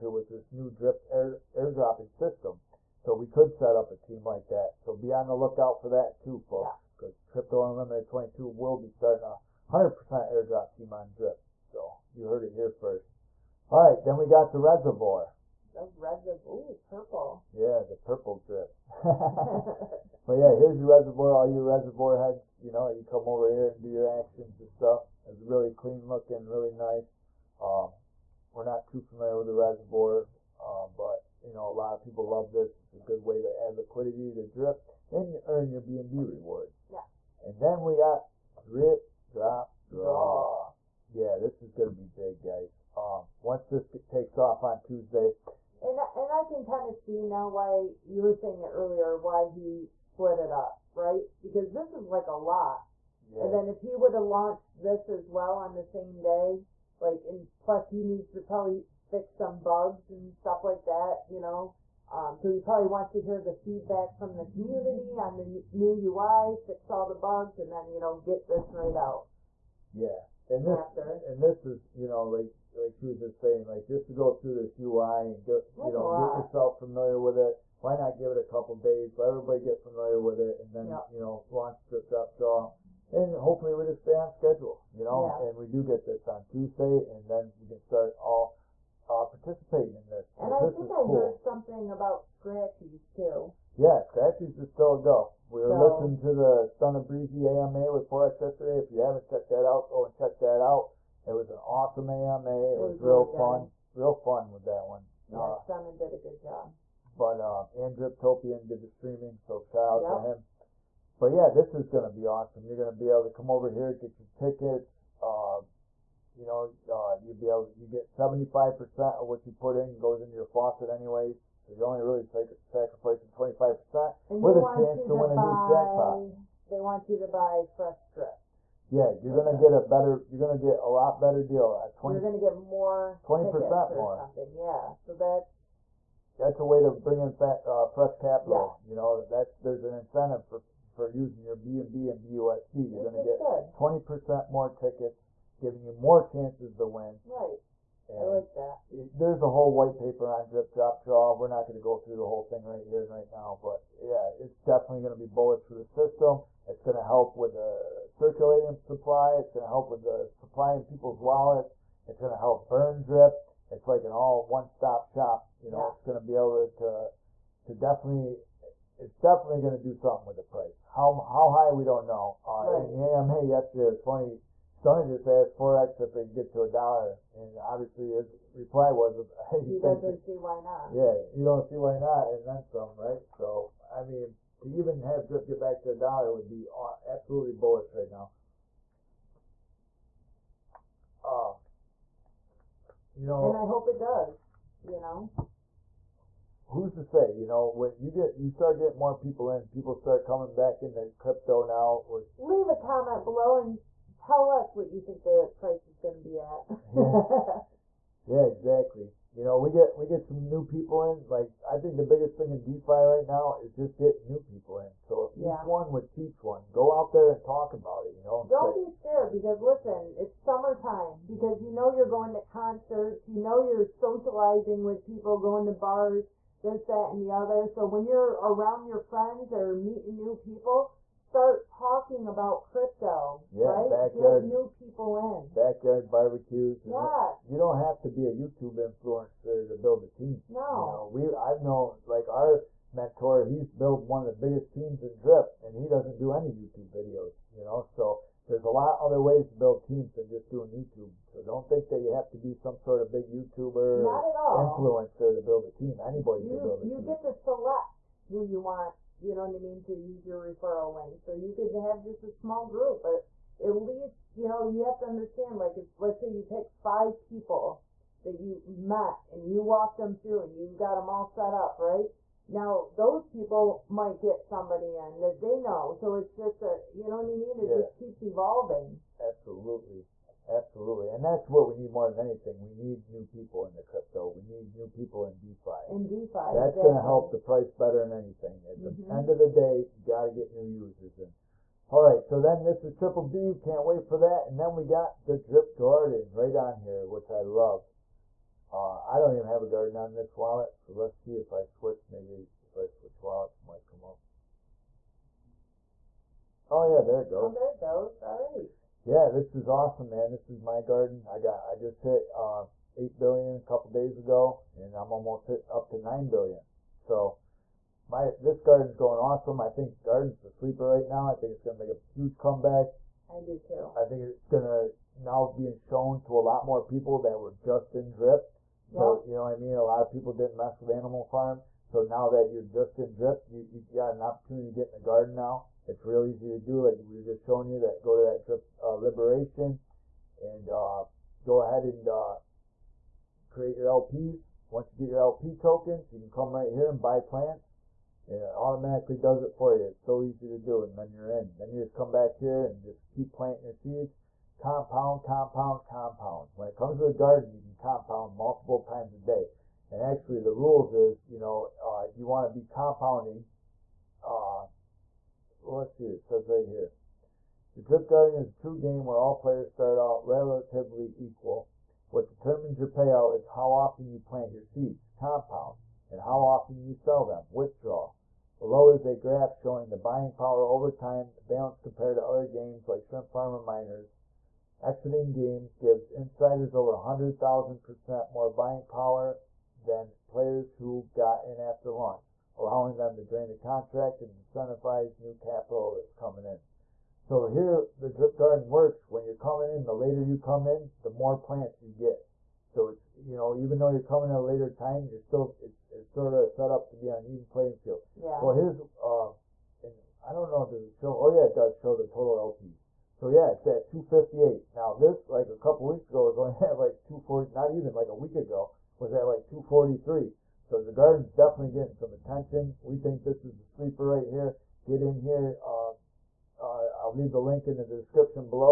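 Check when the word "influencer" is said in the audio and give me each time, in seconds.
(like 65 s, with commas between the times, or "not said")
238 s, 254 s.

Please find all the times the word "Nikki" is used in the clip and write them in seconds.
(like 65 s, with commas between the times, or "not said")
not said.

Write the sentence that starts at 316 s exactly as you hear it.
So my this garden's growing awesome.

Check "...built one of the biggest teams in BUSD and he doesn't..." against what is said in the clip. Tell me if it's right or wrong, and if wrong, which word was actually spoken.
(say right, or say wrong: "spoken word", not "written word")
wrong: "Drip", not "BUSD".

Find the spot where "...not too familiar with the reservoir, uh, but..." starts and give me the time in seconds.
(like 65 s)
28 s.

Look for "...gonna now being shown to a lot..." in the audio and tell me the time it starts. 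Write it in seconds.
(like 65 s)
324 s.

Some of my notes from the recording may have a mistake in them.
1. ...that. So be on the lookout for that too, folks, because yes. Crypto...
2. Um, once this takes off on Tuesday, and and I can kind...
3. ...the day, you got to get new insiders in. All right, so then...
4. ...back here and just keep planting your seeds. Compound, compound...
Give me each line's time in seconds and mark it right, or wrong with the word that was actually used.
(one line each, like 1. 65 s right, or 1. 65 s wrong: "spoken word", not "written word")
1. 4 s right
2. 42 s right
3. 289 s wrong: "users", not "insiders"
4. 352 s right.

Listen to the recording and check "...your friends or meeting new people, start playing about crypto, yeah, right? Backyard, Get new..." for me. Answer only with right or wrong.
wrong.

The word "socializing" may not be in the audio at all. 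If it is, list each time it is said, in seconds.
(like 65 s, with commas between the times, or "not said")
223 s.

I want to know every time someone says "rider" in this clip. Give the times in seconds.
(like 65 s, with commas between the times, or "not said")
not said.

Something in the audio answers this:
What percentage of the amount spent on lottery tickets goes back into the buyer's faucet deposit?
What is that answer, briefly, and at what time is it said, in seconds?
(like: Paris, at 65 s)
75%, at 118 s.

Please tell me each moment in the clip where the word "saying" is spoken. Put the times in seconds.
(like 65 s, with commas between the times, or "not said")
48 s, 73 s.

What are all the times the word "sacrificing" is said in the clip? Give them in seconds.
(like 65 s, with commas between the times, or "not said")
122 s.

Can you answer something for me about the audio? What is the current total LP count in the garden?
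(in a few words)
258.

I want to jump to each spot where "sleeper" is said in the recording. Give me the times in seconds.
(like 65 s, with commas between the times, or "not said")
320 s, 423 s.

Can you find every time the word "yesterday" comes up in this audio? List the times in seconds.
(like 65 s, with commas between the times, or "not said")
98 s, 173 s.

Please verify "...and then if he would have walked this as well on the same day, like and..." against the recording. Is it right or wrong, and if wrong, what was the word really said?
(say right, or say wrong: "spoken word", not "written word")
wrong: "launched", not "walked".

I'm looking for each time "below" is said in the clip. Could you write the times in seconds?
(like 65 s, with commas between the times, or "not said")
203 s, 378 s.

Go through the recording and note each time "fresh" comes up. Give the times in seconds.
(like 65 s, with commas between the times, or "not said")
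127 s, 137 s.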